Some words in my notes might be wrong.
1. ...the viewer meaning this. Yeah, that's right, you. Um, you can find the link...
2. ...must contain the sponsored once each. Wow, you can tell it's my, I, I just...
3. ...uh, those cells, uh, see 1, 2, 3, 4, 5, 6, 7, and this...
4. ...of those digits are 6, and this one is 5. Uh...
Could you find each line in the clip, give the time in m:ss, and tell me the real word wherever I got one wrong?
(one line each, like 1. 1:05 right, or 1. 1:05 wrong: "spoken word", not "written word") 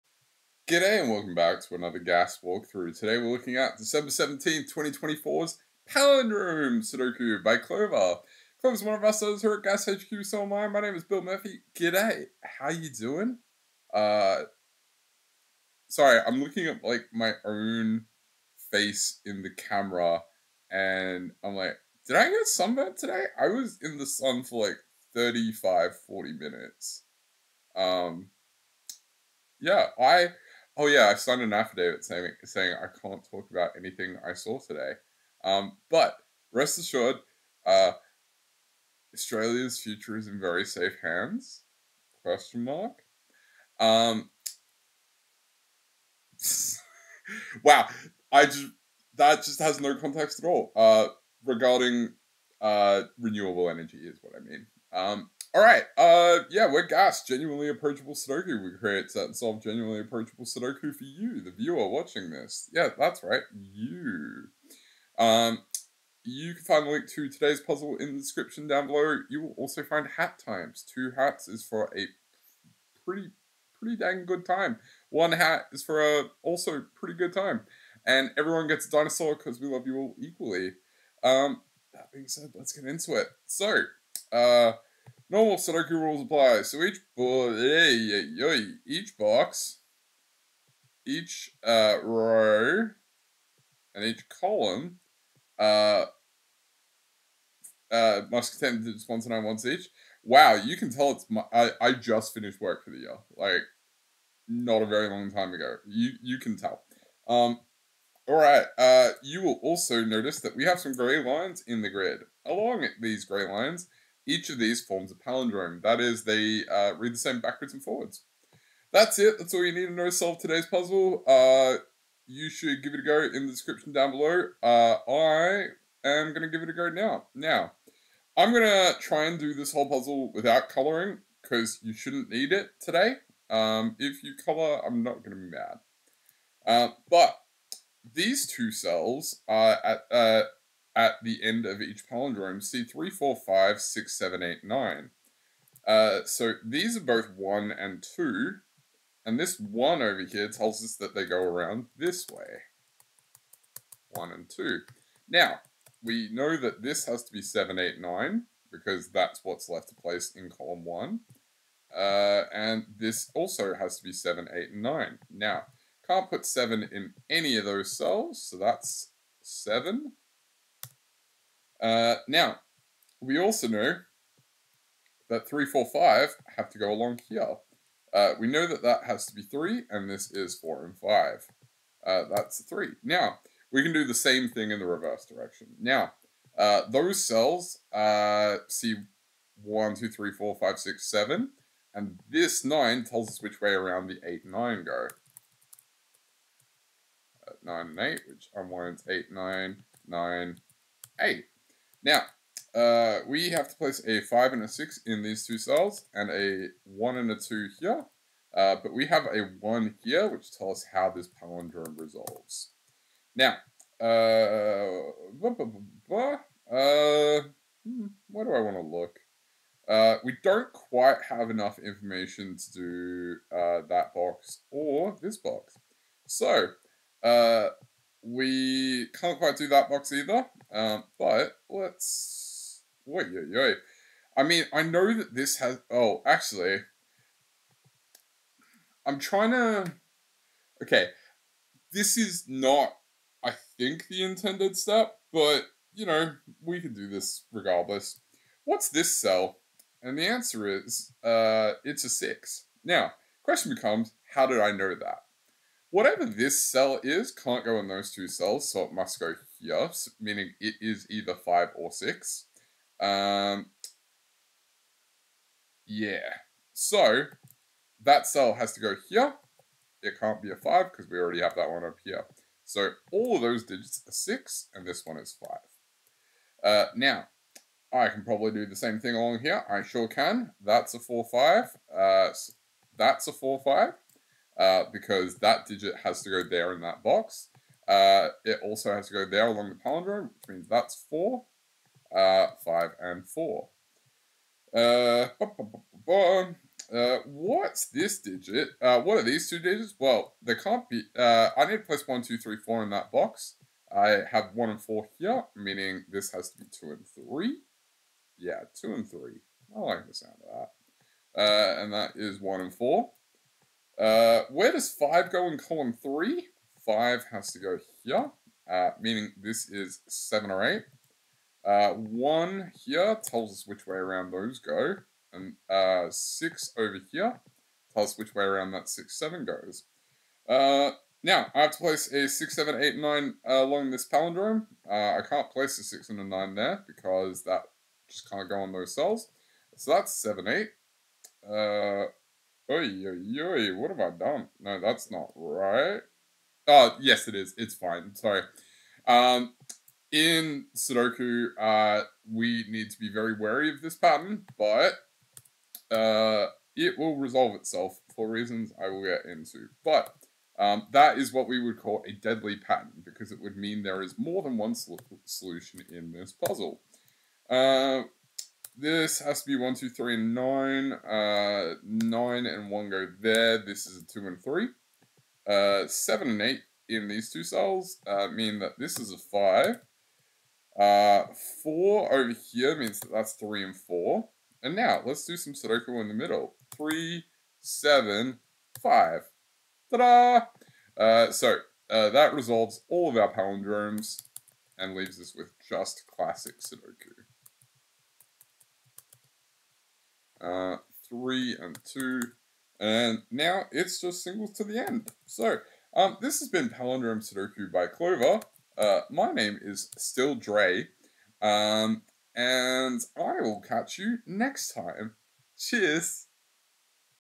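1. 1:01 wrong: "watching", not "meaning"
2. 1:38 right
3. 3:06 right
4. 4:33 right.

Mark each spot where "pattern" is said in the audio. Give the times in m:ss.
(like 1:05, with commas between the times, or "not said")
5:53, 6:02.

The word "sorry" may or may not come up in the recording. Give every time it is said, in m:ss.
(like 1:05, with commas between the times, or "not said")
0:15, 5:48.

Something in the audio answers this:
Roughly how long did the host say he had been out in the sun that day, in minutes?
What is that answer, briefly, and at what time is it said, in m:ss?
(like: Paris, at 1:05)
35-40 minutes, at 0:25.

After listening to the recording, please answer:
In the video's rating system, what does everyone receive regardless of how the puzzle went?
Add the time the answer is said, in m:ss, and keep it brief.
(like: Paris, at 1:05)
a dinosaur, at 1:18.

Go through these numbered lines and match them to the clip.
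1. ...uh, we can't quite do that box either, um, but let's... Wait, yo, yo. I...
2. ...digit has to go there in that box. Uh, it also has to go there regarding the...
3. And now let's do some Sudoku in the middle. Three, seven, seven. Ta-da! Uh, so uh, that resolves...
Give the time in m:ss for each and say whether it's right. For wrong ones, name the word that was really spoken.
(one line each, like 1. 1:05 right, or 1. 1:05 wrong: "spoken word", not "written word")
1. 3:47 right
2. 4:45 wrong: "along", not "regarding"
3. 6:24 wrong: "five", not "seven".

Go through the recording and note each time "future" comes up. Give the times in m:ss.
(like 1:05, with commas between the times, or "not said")
0:39.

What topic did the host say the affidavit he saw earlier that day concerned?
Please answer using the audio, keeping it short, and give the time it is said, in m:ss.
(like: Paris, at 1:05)
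renewable energy, at 0:53.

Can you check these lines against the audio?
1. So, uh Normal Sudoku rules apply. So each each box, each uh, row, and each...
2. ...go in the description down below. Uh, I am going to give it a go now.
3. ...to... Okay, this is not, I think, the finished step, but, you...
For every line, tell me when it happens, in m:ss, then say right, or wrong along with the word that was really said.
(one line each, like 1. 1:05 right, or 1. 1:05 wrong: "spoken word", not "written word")
1. 1:23 right
2. 2:03 right
3. 3:59 wrong: "intended", not "finished".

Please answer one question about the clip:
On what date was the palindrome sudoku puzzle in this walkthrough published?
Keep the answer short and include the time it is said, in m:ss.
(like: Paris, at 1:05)
December 17th, 2024, at 0:03.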